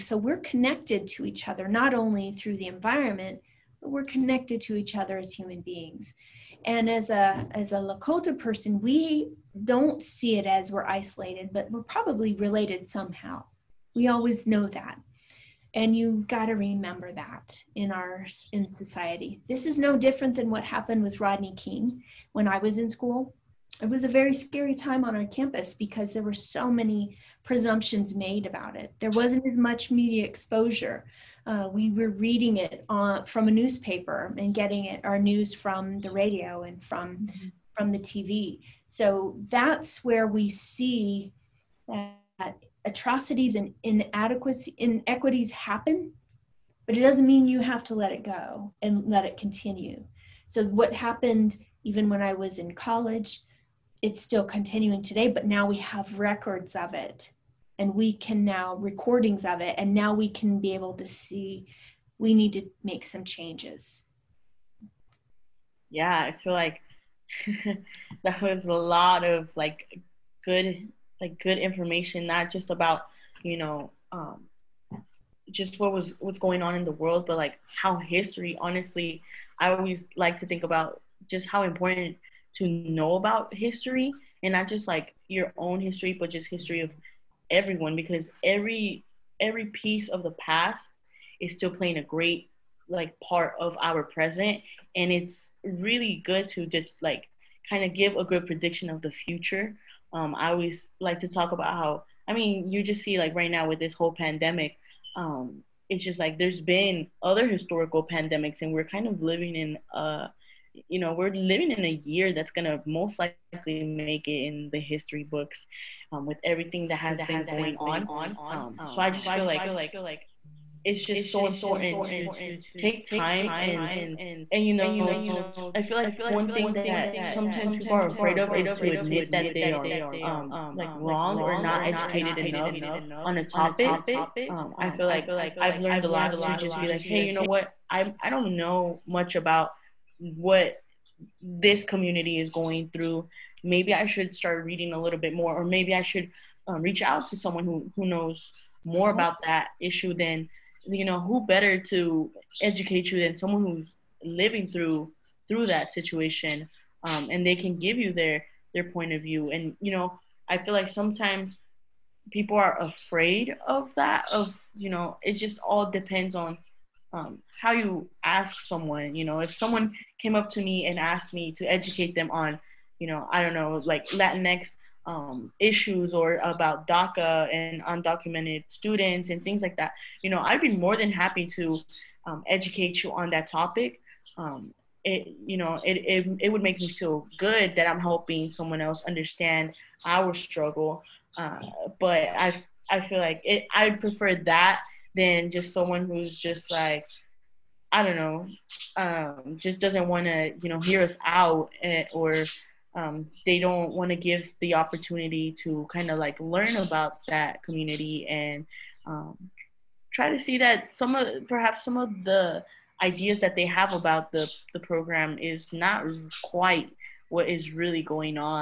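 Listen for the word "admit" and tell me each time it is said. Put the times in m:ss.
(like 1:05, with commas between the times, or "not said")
2:08.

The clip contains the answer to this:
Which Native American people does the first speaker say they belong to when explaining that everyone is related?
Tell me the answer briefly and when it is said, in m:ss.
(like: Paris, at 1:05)
Lakota, at 0:07.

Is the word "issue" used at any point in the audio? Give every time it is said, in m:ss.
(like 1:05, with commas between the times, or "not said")
2:29, 2:55.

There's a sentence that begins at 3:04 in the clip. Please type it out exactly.
Um, it, you know, it, it, it would make me feel good that I'm helping someone else understand our struggle.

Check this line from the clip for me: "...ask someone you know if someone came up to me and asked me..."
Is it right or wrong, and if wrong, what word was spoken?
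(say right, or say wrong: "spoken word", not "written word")
right.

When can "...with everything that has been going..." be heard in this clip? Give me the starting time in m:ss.
1:56.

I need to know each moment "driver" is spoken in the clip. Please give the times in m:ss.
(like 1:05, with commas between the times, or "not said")
not said.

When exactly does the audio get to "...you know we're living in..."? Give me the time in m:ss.
1:50.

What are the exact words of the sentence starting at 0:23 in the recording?
It was a very scary time on our campus because there were so many presumptions made about it.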